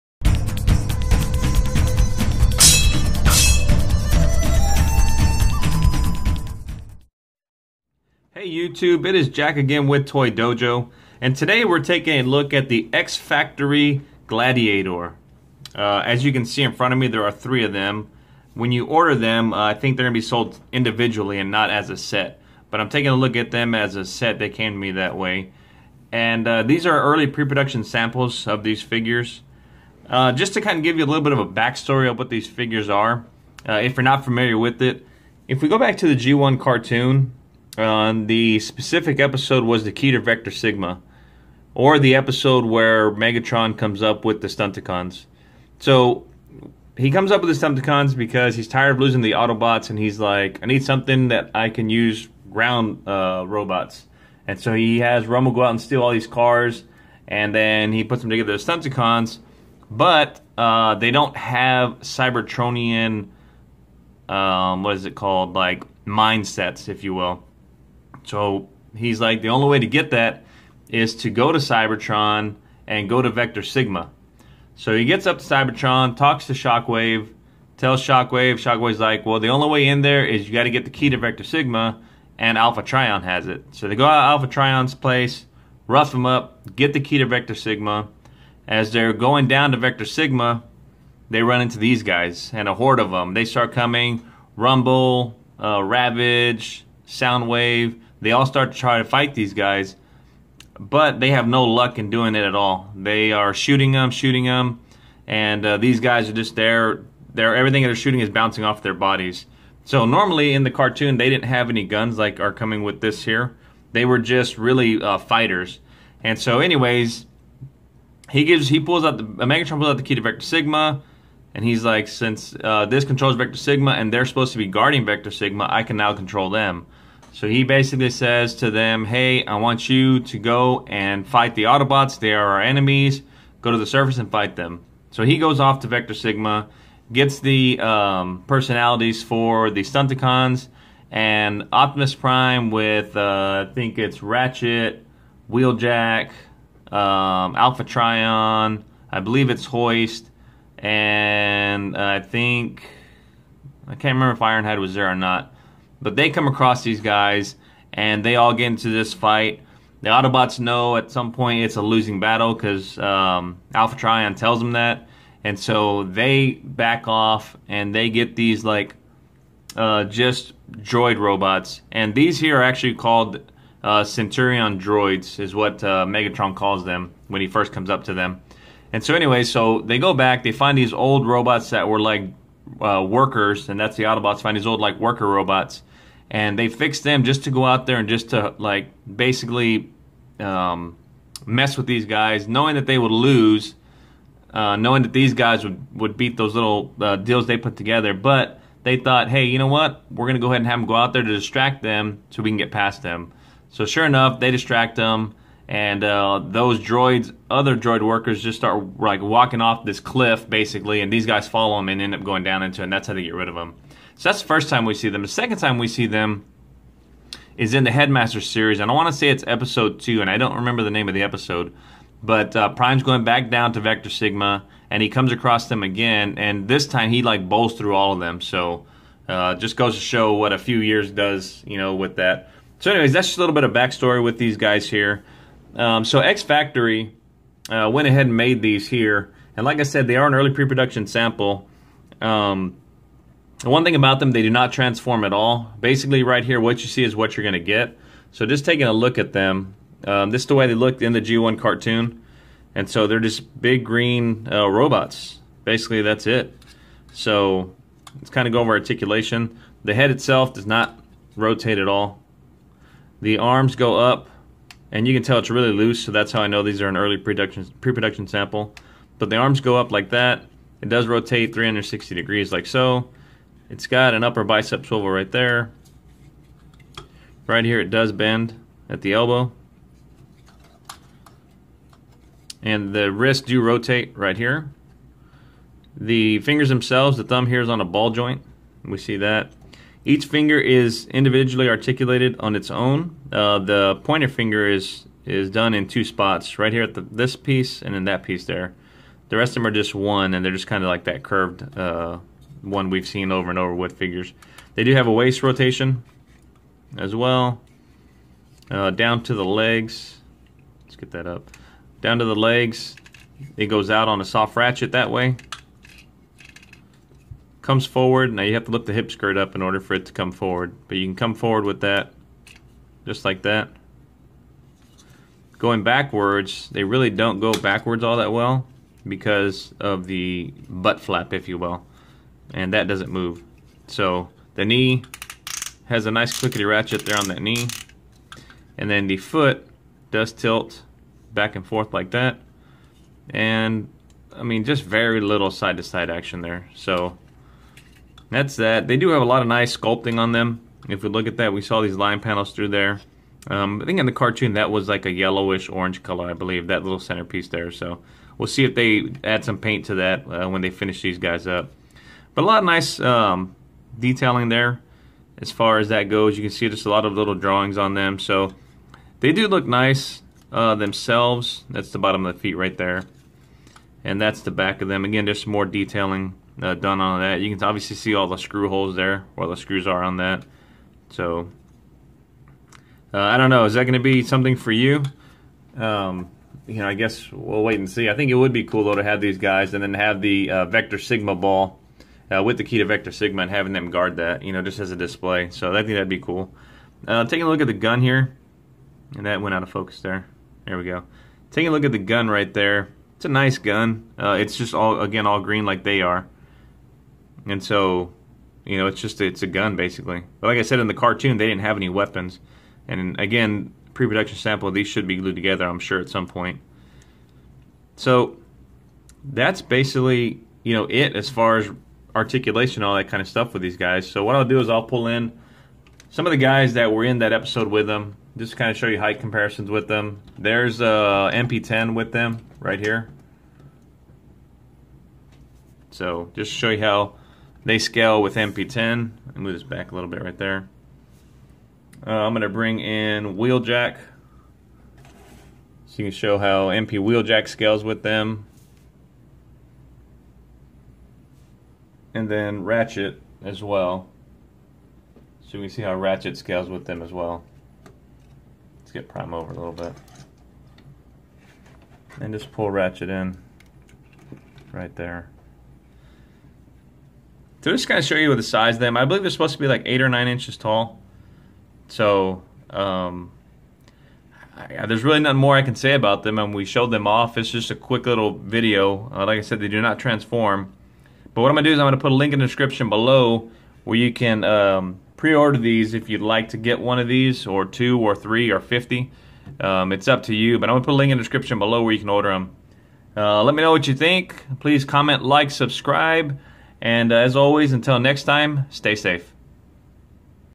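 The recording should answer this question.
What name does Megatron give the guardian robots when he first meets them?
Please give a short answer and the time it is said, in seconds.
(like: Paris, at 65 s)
Centurion droids, at 174 s.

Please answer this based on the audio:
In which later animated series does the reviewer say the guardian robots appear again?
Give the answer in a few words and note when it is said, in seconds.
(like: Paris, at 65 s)
Headmaster series, at 217 s.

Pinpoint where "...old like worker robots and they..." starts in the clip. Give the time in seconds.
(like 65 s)
184 s.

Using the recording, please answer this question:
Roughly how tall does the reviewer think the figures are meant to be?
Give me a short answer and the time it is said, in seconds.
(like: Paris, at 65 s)
8 or 9 inches, at 469 s.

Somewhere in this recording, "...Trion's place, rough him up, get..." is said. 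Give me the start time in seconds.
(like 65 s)
84 s.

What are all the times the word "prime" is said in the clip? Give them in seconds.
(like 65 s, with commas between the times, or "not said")
142 s, 222 s, 459 s.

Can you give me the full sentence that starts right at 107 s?
They're, everything they're shooting is bouncing off their bodies.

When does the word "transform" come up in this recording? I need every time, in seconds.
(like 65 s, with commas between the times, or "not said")
244 s, 479 s.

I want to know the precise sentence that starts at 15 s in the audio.
Uh, as you can see in front of me, there are three of them.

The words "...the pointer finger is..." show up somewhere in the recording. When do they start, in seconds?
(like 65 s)
293 s.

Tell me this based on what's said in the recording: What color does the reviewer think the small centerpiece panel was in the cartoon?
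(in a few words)
Yellowish orange.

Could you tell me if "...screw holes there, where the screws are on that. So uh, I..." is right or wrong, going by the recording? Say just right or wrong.
right.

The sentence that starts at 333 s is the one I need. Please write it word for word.
So the knee has a nice clickety ratchet there on that knee.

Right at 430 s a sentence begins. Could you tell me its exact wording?
There's a uh, MP10 with them right here.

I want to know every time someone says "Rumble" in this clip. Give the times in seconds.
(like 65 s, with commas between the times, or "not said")
55 s, 94 s.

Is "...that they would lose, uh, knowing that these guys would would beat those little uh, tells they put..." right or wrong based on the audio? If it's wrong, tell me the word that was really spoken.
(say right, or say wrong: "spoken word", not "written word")
wrong: "deals", not "tells".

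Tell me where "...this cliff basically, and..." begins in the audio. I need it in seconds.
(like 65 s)
209 s.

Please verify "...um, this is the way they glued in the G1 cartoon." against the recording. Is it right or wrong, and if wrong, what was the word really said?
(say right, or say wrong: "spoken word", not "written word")
wrong: "looked", not "glued".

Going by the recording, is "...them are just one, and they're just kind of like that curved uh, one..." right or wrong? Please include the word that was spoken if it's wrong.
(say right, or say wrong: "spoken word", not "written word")
right.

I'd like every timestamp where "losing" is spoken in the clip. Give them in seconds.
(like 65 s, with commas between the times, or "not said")
48 s, 161 s.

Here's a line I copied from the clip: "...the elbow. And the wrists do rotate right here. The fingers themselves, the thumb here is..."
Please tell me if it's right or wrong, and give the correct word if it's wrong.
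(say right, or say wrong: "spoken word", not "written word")
right.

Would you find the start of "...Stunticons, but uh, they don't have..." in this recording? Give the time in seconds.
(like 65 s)
58 s.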